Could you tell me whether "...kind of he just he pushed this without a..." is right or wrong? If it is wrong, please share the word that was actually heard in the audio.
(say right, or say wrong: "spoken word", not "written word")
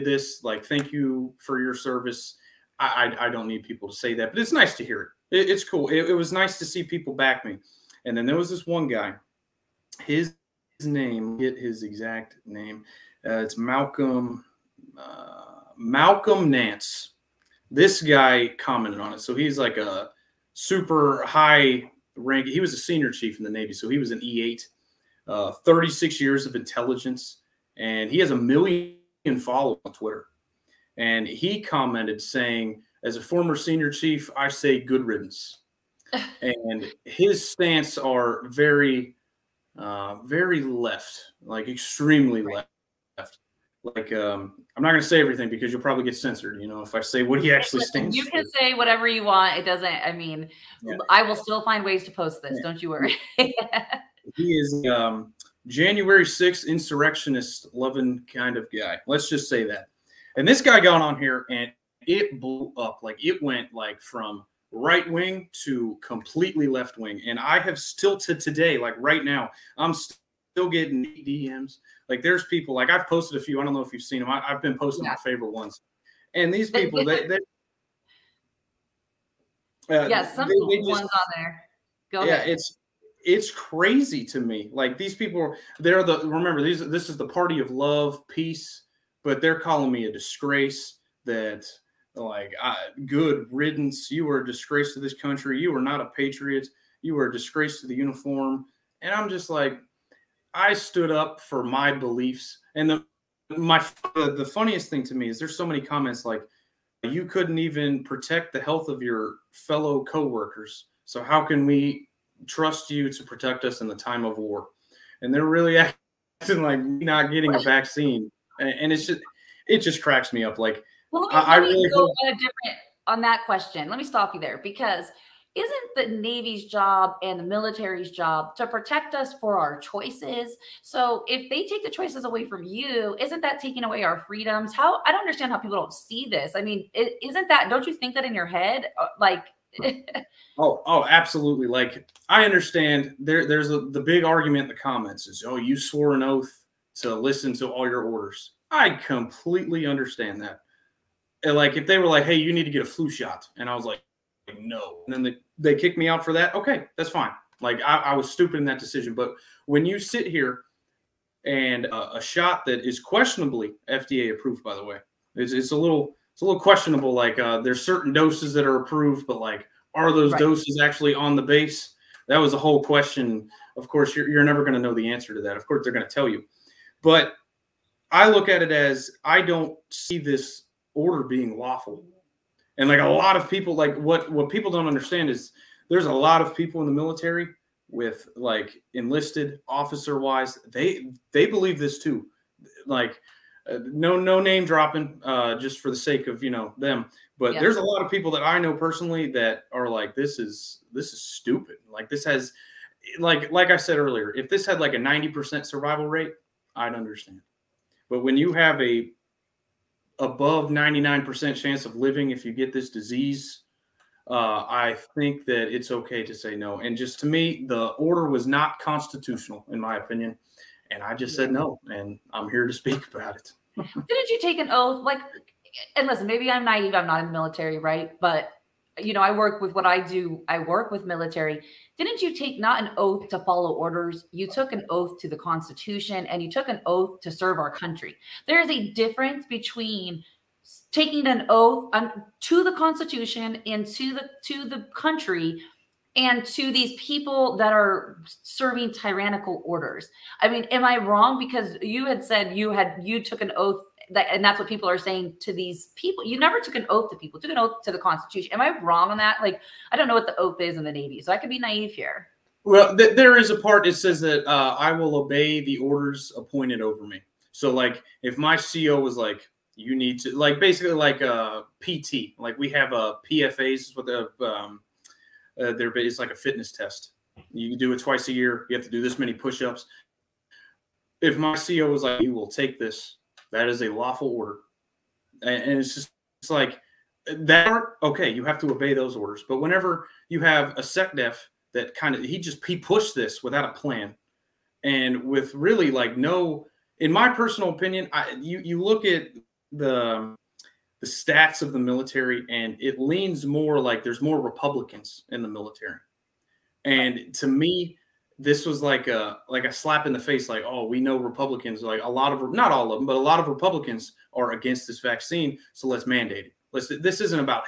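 right.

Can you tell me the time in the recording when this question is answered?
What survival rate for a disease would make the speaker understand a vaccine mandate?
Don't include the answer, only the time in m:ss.
3:24.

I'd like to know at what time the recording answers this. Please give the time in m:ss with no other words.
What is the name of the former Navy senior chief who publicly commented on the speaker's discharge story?
0:15.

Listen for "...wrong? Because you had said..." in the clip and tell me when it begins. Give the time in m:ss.
4:10.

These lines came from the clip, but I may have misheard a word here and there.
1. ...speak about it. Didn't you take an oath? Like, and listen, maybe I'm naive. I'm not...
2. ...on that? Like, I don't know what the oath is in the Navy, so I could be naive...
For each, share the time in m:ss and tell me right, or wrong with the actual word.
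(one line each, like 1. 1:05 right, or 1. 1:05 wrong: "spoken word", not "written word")
1. 3:42 right
2. 4:19 right.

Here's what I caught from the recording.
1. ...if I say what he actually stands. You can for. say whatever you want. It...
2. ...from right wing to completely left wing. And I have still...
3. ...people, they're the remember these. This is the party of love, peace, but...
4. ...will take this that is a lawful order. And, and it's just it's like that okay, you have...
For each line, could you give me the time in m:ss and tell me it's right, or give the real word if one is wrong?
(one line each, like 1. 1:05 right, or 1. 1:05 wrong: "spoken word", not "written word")
1. 0:46 right
2. 1:04 right
3. 1:25 right
4. 4:42 right.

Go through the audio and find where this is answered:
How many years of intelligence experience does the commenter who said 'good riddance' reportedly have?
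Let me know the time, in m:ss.
0:25.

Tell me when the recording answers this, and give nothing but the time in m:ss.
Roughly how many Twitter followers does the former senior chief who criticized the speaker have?
0:28.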